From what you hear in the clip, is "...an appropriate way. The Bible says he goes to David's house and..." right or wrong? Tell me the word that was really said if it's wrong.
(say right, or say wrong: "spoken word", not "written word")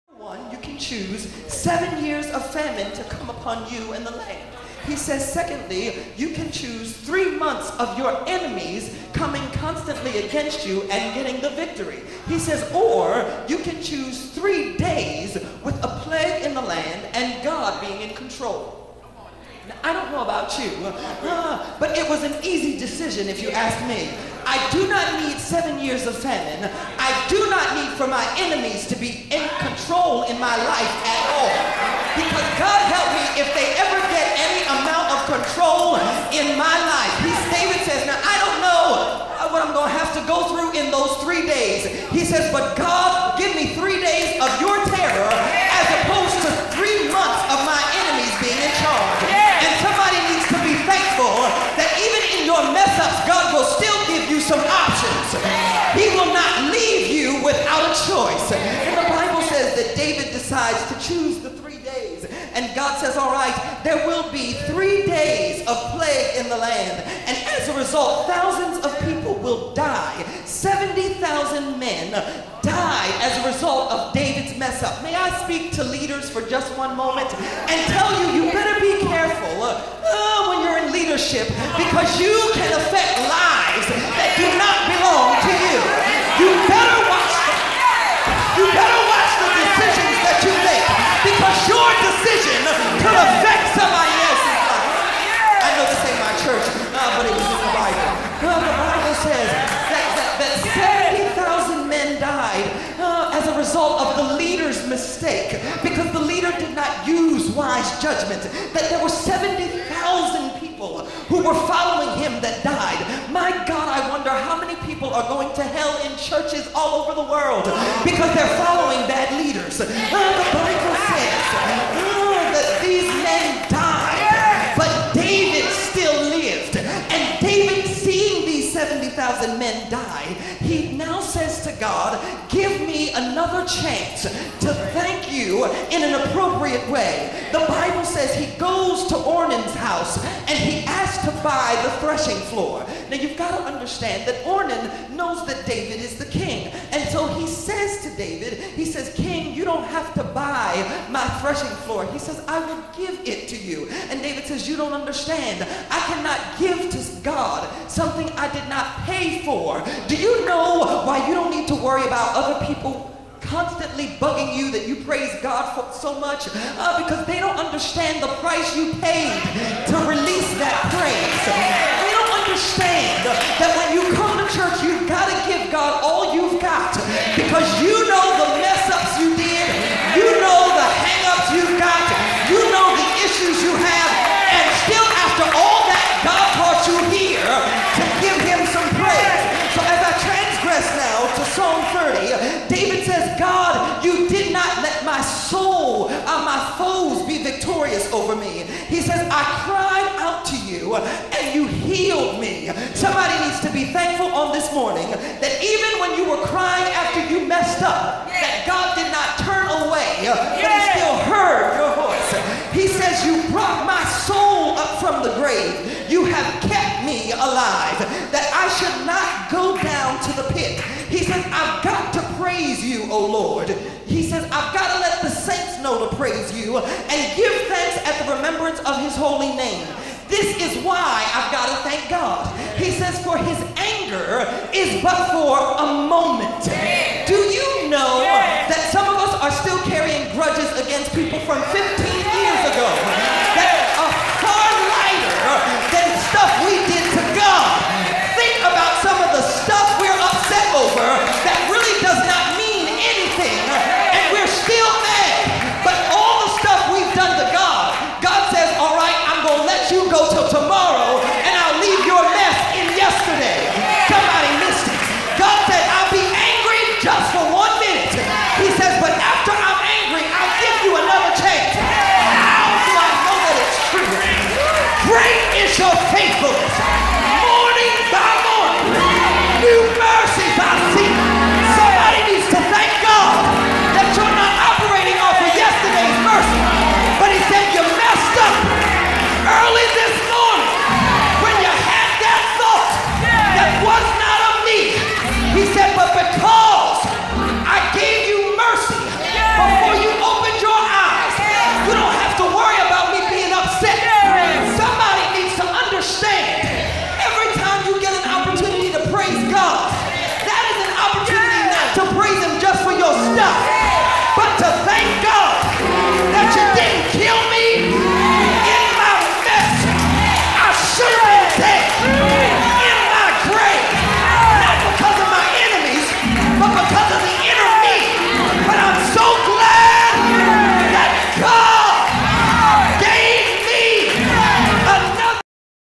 wrong: "Ornan", not "David".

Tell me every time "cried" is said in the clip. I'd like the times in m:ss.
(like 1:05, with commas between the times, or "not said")
3:19.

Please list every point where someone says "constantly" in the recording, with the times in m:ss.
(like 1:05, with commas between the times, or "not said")
0:09, 2:43.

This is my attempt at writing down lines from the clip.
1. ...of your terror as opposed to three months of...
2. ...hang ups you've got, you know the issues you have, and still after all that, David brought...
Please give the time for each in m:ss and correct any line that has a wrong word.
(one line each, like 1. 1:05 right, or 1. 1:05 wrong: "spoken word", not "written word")
1. 0:44 right
2. 3:01 wrong: "God", not "David".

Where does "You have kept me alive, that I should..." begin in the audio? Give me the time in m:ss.
3:36.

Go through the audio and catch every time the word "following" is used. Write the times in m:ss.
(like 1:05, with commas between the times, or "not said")
1:51, 1:58.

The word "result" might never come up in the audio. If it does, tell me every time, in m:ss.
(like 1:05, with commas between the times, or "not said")
1:07, 1:13.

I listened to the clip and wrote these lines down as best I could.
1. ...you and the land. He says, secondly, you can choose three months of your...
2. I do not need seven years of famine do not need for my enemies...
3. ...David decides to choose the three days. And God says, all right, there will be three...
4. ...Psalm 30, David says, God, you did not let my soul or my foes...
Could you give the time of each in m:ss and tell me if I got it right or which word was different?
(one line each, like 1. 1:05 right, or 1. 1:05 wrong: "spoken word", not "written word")
1. 0:03 right
2. 0:24 right
3. 0:59 right
4. 3:11 right.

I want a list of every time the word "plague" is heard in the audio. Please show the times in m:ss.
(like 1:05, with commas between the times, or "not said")
0:16, 1:05.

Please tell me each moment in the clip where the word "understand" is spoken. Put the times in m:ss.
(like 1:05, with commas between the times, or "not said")
2:23, 2:34, 2:47, 2:52.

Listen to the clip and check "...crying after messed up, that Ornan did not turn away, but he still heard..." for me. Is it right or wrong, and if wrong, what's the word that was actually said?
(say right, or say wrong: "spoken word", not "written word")
wrong: "God", not "Ornan".